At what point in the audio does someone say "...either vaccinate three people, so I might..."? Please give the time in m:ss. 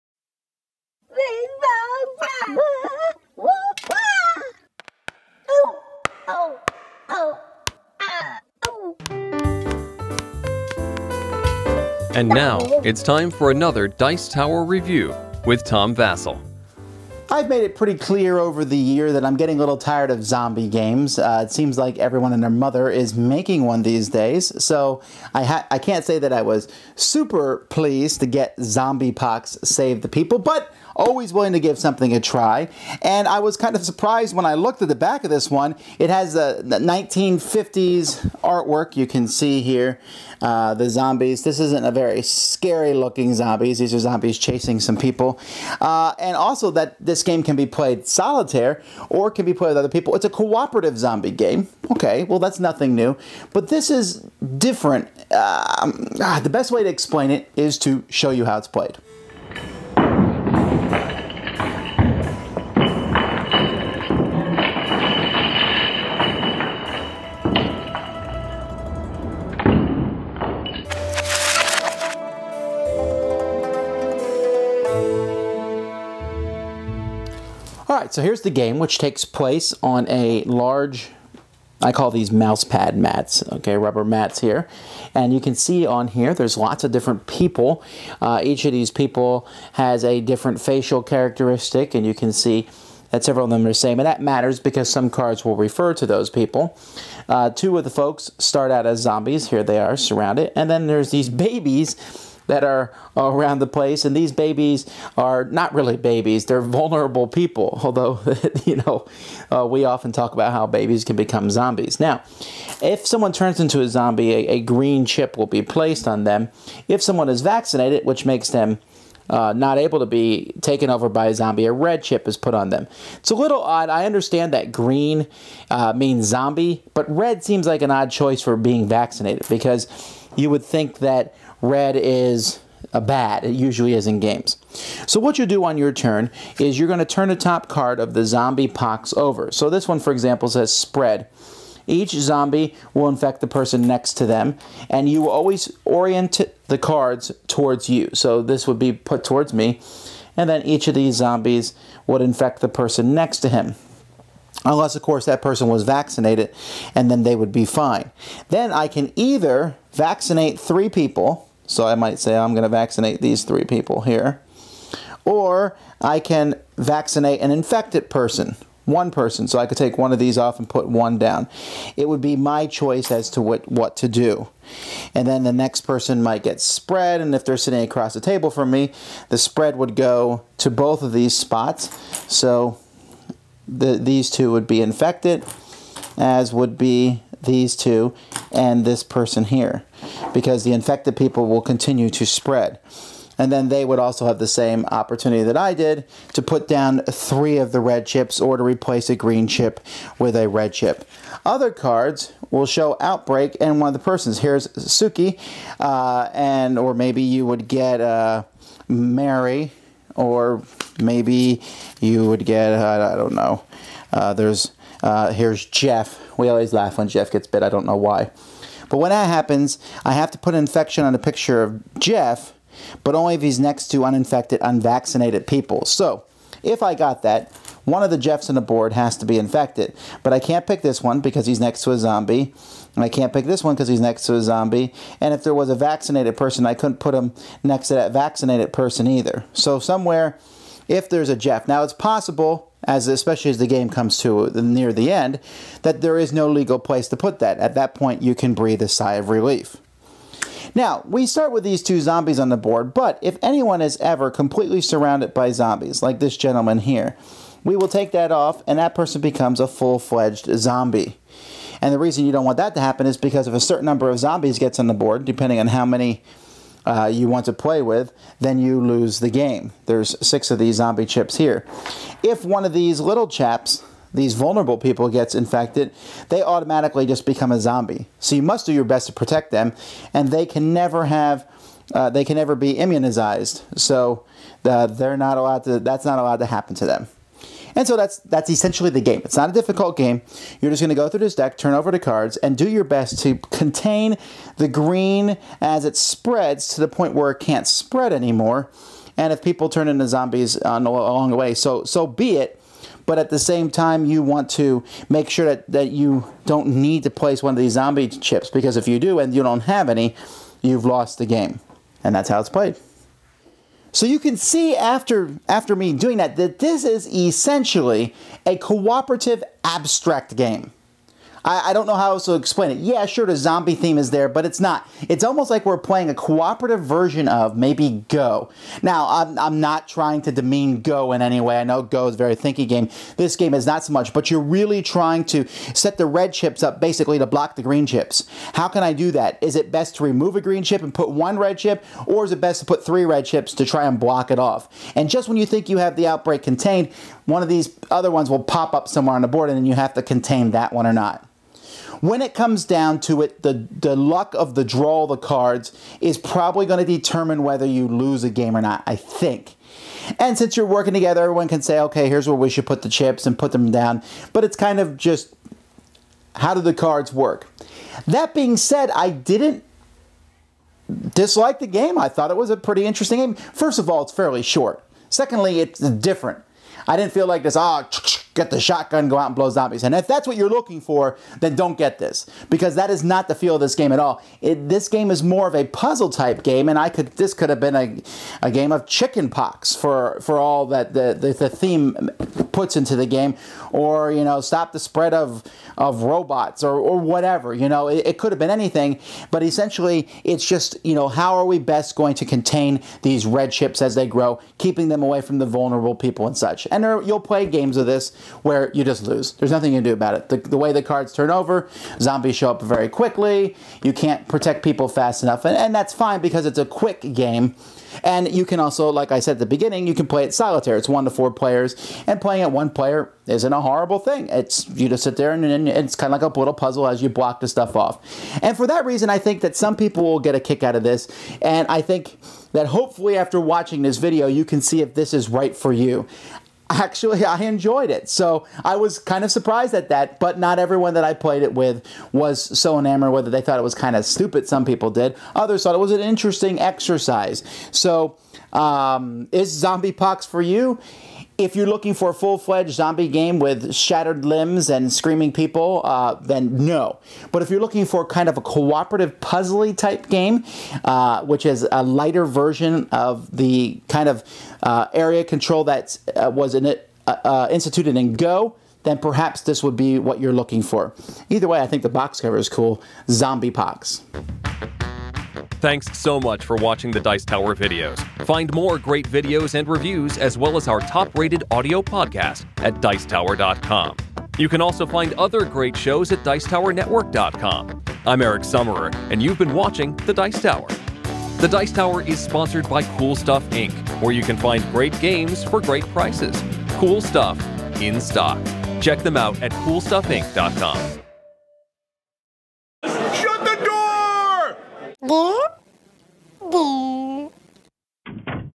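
2:39.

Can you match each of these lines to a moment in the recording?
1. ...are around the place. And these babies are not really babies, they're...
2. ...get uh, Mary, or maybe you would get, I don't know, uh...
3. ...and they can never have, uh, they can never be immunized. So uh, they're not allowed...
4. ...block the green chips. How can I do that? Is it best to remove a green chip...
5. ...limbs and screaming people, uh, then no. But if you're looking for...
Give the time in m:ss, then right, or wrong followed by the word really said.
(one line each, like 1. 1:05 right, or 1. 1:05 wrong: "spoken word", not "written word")
1. 1:42 right
2. 3:27 right
3. 4:40 right
4. 5:37 right
5. 7:34 right.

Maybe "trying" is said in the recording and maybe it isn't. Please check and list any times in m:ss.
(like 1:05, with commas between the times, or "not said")
5:29, 5:34.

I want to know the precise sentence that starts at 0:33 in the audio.
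And I was kind of surprised when I looked at the back of this one.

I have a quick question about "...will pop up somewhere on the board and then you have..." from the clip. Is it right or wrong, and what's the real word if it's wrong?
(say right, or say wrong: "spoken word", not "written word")
right.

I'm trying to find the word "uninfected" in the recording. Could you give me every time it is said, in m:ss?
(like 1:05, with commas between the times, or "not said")
3:44.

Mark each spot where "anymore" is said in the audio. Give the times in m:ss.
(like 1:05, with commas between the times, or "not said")
4:58.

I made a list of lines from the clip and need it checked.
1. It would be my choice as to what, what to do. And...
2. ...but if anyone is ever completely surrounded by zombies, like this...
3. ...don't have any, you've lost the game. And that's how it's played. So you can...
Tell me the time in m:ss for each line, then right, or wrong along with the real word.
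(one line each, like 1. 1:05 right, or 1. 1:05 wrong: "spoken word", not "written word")
1. 2:51 right
2. 4:12 right
3. 5:09 right.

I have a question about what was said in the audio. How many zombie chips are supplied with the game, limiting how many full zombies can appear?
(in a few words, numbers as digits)
6.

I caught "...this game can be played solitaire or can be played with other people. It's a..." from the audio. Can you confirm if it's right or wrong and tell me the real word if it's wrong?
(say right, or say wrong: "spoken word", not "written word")
right.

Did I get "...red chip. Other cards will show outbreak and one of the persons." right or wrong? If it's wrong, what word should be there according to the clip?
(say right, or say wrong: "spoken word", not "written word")
right.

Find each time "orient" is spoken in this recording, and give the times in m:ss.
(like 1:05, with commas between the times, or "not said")
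2:25.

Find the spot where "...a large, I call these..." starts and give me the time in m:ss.
1:20.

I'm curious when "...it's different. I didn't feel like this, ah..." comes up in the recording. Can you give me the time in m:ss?
6:15.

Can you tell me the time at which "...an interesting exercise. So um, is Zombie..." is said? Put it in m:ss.
7:25.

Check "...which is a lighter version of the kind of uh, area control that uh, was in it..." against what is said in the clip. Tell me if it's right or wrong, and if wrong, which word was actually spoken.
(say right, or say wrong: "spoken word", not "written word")
right.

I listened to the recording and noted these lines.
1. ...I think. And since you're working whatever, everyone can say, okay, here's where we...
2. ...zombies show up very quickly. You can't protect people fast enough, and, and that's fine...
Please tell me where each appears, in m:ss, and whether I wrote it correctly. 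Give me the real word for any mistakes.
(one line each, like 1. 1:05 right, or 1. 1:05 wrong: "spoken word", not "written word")
1. 5:58 wrong: "together", not "whatever"
2. 6:51 right.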